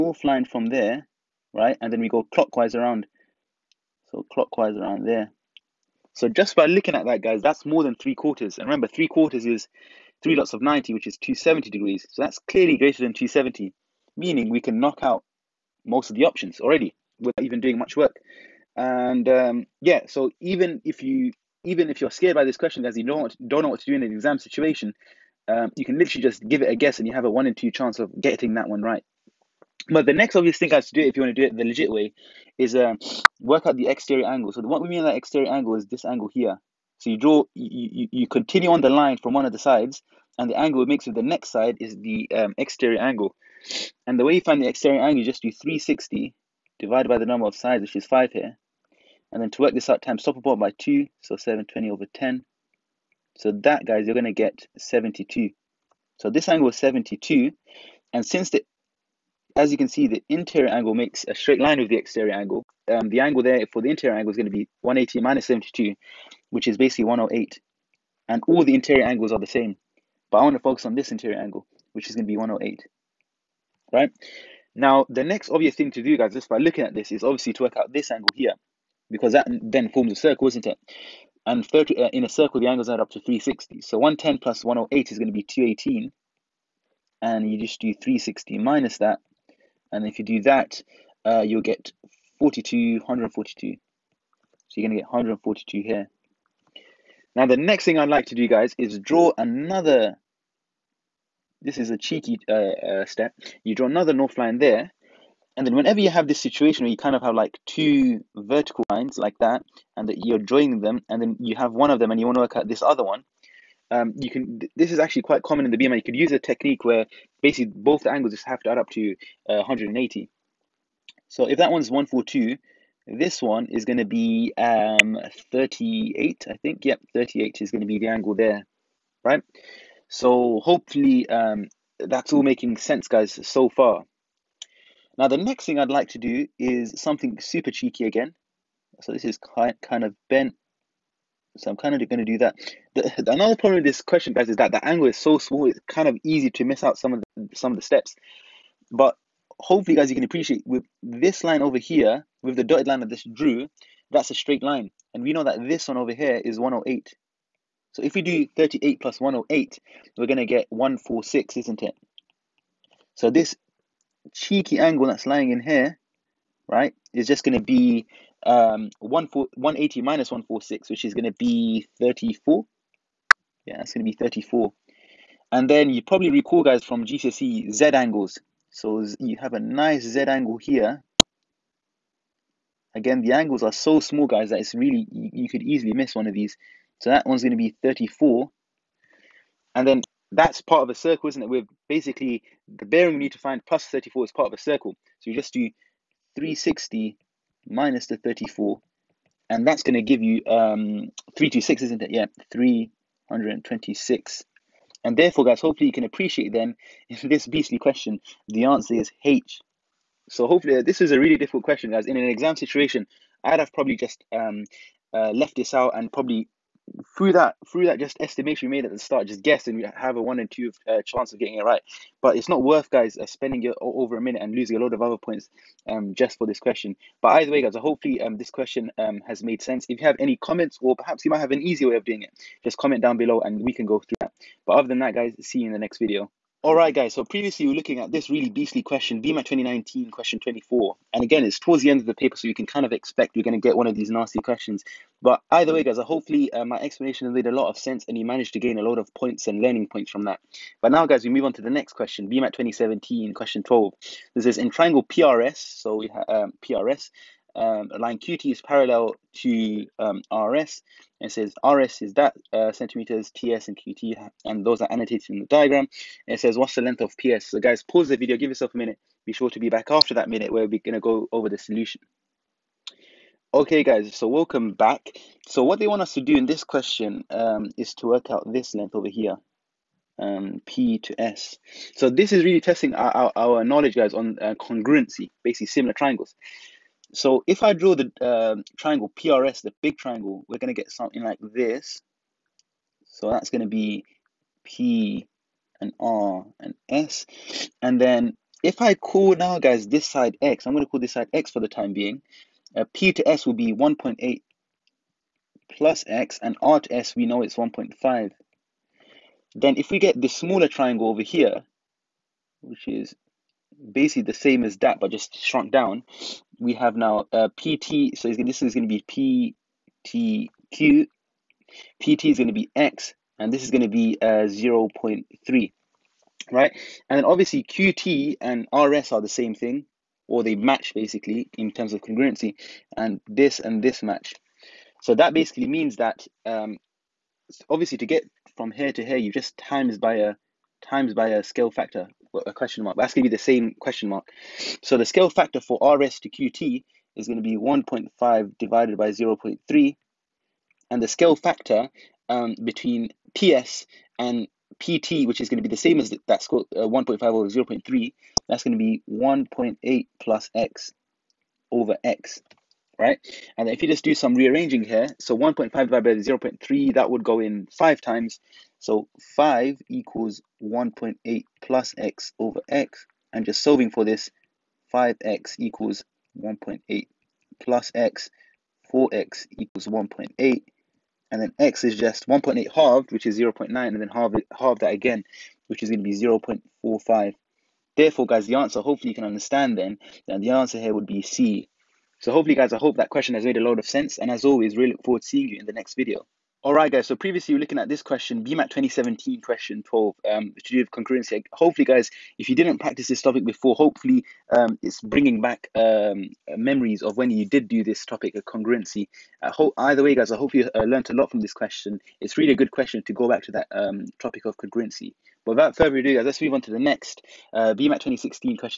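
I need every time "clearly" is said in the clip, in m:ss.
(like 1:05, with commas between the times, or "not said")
0:12.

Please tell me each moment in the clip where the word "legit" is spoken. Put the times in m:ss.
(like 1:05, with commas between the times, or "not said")
0:31.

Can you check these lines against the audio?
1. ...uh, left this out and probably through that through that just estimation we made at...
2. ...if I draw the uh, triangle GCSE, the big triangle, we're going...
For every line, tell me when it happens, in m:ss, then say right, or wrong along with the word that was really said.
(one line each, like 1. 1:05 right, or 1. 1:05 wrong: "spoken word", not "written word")
1. 3:35 right
2. 4:47 wrong: "PRS", not "GCSE".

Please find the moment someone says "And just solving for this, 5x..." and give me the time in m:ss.
6:13.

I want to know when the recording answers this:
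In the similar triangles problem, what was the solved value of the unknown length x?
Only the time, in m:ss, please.
6:26.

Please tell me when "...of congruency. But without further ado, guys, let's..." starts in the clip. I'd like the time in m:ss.
6:54.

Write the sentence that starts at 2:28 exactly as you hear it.
But hopefully, guys, you can appreciate with this line over here, with the dotted line that this drew, that's a straight line.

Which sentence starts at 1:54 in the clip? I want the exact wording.
This is actually quite common in the BMI.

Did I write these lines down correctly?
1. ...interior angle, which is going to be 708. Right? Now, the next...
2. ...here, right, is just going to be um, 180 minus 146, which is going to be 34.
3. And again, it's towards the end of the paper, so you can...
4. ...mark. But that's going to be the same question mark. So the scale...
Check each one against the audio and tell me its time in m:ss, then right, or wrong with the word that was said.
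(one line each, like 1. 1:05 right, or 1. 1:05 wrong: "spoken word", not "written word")
1. 1:11 wrong: "108", not "708"
2. 2:45 right
3. 4:01 right
4. 5:42 right.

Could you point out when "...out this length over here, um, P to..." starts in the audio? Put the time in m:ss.
4:38.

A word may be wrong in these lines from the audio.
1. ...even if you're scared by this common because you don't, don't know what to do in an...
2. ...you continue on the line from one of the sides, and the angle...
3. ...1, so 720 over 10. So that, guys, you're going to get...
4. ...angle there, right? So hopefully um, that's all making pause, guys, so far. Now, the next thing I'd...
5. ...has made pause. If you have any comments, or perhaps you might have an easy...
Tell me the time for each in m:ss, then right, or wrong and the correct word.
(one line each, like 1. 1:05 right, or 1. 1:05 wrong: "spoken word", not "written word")
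1. 0:21 wrong: "question", not "common"
2. 0:38 right
3. 0:50 wrong: "2", not "1"
4. 2:08 wrong: "sense", not "pause"
5. 3:49 wrong: "sense", not "pause".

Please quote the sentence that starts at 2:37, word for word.
So if we do 38 plus 108, we're going to get 146, isn't it?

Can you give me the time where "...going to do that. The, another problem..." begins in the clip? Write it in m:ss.
2:22.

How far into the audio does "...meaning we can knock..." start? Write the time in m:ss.
0:14.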